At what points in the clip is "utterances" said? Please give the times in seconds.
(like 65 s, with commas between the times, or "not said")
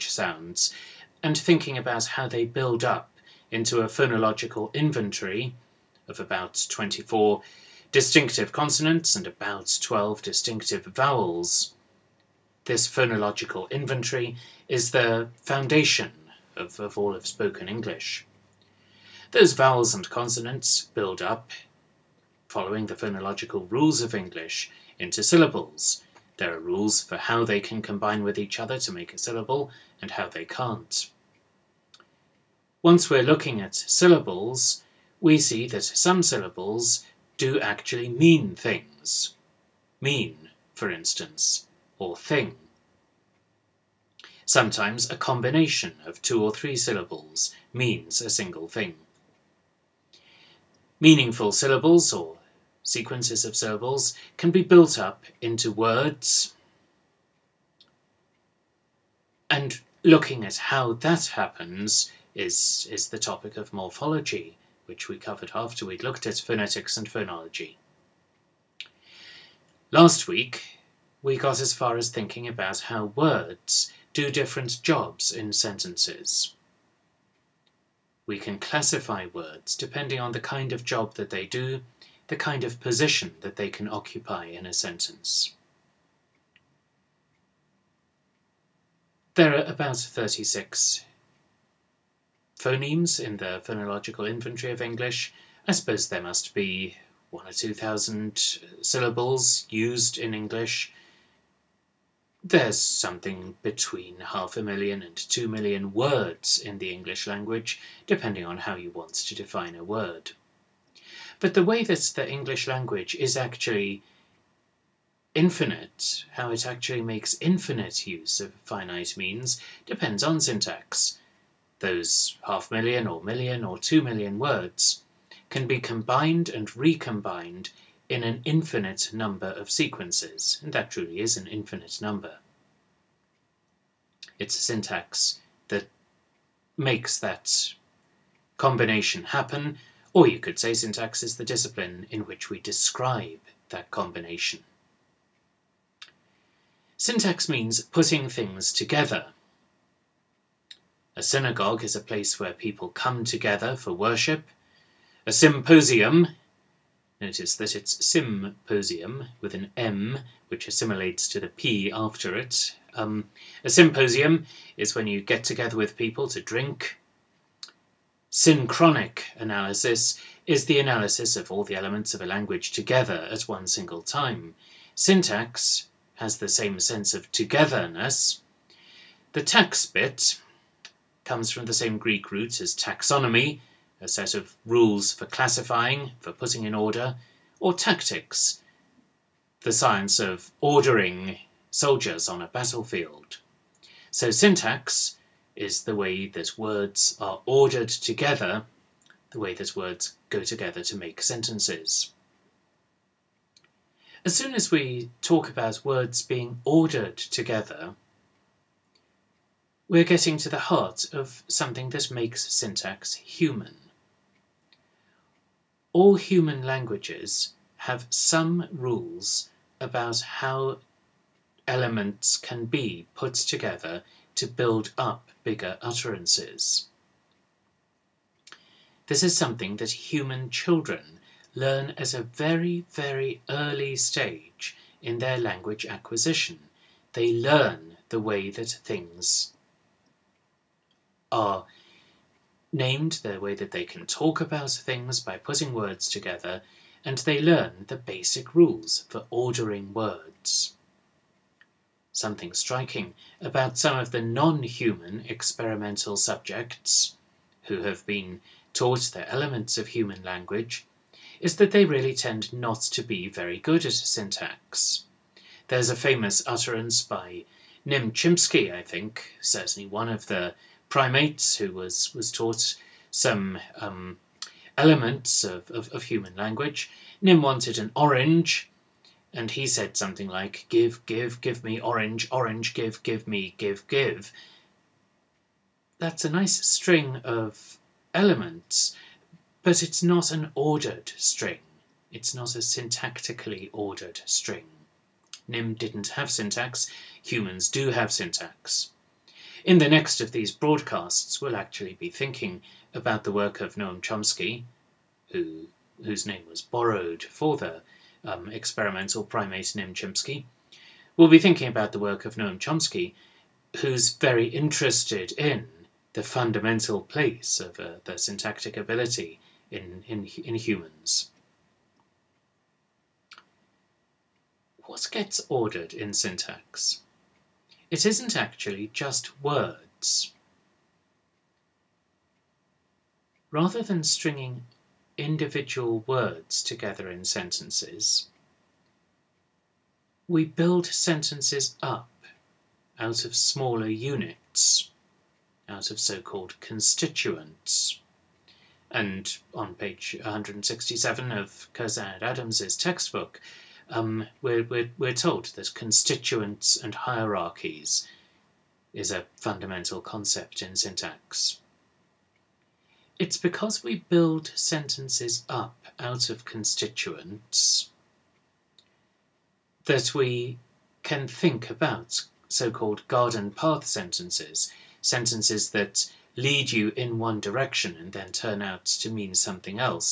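225 s, 266 s.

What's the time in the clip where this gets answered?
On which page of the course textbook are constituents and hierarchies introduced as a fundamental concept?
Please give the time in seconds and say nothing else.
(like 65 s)
350 s.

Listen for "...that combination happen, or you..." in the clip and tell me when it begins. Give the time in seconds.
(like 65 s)
137 s.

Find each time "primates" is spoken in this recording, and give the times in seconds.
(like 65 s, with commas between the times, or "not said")
270 s, 309 s.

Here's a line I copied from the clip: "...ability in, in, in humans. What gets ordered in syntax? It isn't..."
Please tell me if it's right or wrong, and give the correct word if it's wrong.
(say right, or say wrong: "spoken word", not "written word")
right.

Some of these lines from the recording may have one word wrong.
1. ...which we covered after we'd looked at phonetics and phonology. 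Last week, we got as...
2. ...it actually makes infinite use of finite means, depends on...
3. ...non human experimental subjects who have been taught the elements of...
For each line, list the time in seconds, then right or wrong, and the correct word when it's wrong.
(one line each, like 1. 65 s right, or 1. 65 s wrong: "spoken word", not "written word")
1. 64 s right
2. 116 s right
3. 254 s right.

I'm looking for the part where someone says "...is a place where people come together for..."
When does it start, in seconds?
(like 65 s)
151 s.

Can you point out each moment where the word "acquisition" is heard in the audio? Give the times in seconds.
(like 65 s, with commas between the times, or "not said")
235 s.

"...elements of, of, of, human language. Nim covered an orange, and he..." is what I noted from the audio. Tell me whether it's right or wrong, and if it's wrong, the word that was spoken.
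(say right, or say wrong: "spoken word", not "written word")
wrong: "wanted", not "covered".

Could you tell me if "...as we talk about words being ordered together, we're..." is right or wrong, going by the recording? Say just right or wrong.
right.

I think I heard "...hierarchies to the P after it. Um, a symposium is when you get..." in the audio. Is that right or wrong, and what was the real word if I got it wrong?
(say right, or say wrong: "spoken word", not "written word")
wrong: "assimilates", not "hierarchies".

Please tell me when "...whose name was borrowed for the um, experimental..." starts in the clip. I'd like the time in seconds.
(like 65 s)
306 s.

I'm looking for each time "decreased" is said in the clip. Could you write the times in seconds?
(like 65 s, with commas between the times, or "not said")
not said.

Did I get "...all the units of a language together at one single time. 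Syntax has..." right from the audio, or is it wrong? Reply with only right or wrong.
wrong.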